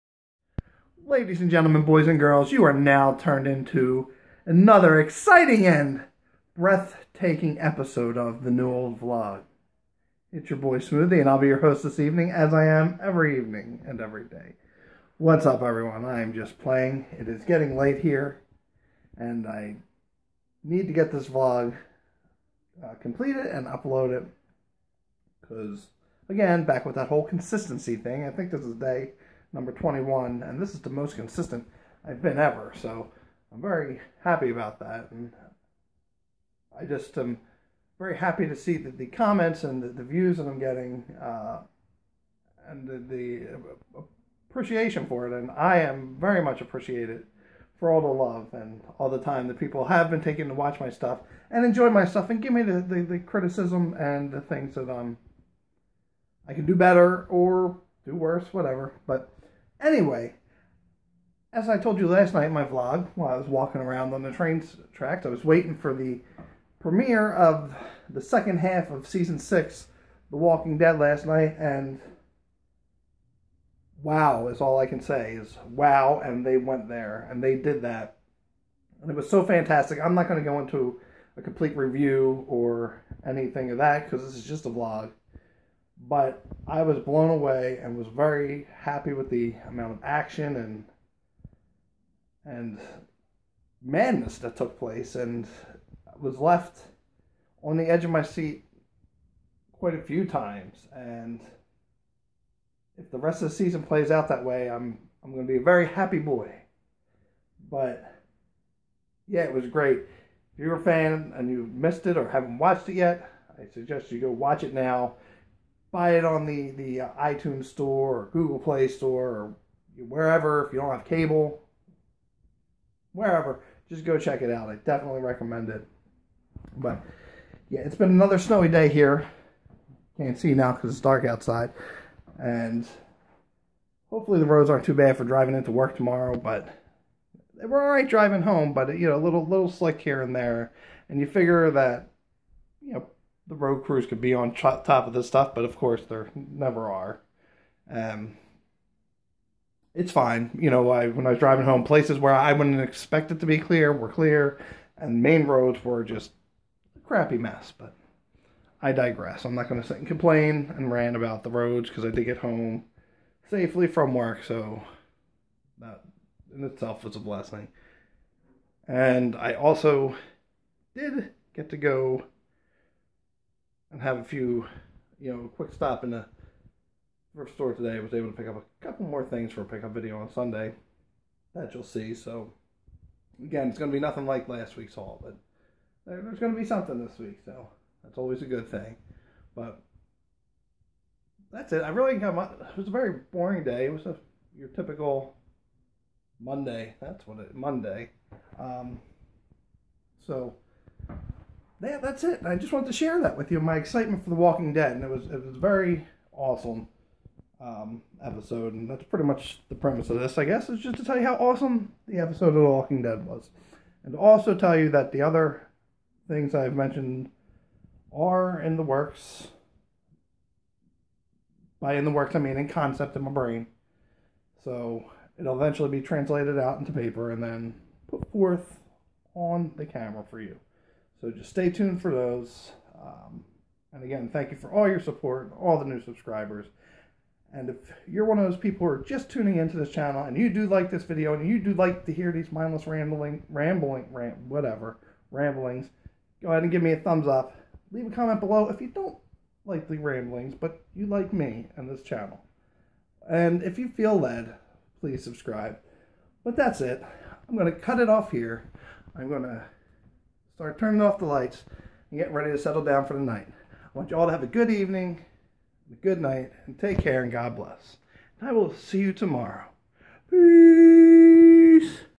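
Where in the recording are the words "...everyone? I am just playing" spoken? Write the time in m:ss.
0:15.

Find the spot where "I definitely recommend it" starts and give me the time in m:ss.
2:04.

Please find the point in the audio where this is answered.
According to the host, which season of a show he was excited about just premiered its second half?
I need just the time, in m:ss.
1:09.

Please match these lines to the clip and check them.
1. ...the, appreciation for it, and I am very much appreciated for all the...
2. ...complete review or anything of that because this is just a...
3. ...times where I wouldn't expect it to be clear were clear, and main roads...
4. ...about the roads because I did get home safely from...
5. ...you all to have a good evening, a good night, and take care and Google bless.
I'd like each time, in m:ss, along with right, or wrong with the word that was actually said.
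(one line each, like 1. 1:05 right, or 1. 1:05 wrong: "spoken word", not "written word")
1. 0:42 right
2. 1:21 right
3. 2:31 wrong: "places", not "times"
4. 2:41 right
5. 4:24 wrong: "God", not "Google".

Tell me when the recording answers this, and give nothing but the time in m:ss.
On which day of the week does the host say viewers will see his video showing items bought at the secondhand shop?
3:00.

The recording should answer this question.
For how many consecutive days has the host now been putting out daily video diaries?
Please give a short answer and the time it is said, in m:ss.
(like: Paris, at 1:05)
21, at 0:29.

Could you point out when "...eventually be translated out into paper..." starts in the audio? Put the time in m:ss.
3:45.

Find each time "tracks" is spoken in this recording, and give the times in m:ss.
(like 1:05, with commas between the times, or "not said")
1:04.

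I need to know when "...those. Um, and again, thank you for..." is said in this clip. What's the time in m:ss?
3:52.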